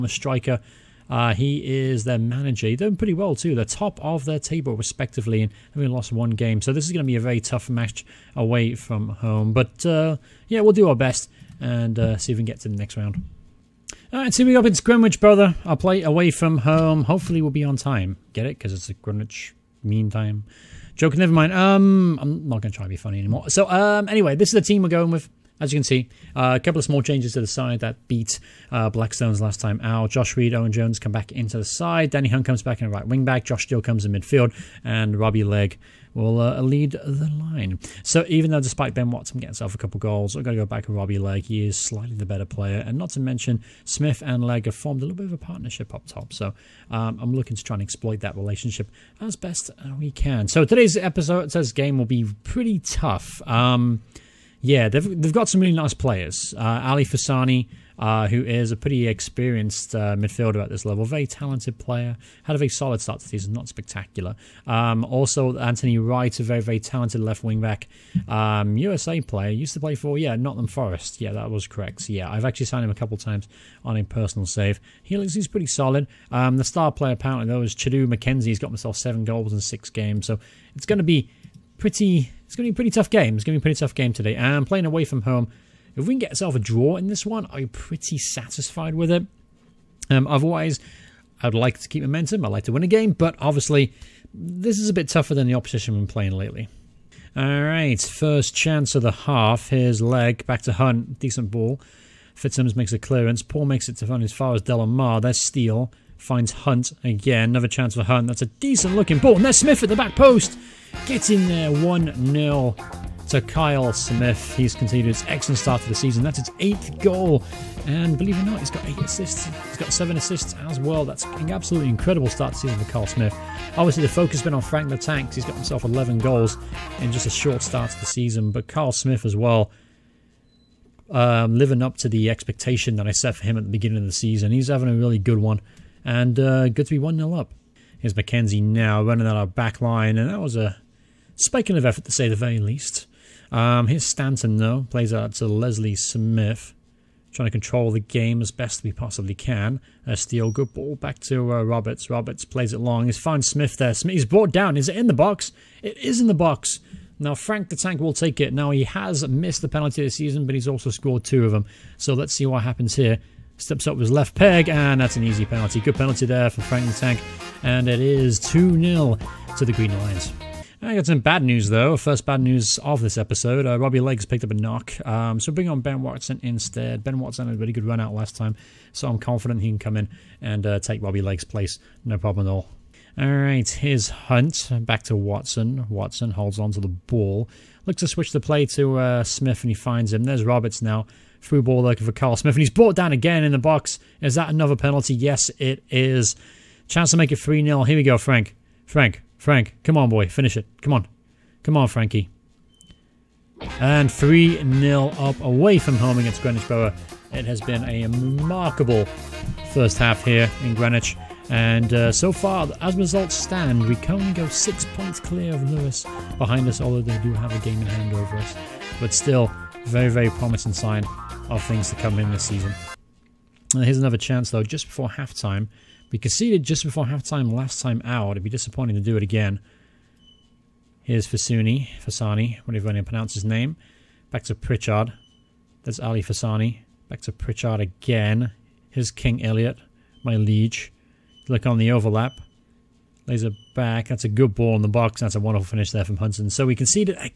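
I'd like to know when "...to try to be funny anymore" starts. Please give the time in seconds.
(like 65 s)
22 s.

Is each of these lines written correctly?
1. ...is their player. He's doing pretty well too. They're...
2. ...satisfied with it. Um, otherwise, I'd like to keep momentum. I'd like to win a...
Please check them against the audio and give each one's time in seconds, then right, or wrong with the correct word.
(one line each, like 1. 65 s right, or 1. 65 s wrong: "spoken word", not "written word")
1. 1 s wrong: "manager", not "player"
2. 88 s right.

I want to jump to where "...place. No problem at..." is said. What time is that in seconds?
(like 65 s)
181 s.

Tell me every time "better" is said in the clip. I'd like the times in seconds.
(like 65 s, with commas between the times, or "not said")
42 s.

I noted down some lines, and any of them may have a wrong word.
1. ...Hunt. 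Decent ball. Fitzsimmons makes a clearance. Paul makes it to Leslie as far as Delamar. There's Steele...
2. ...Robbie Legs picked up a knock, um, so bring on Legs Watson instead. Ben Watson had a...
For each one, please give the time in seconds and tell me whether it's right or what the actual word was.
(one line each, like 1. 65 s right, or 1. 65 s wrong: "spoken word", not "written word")
1. 100 s wrong: "Hunt", not "Leslie"
2. 173 s wrong: "Ben", not "Legs".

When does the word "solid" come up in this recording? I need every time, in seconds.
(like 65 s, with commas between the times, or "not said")
62 s, 75 s.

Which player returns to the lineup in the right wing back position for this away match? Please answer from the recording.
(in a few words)
Danny Hunt.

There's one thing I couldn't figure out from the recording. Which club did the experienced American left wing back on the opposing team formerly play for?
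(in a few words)
Nottingham Forest.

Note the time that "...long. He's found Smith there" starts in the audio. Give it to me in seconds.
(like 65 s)
152 s.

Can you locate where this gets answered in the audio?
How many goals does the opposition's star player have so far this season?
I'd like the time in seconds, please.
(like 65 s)
78 s.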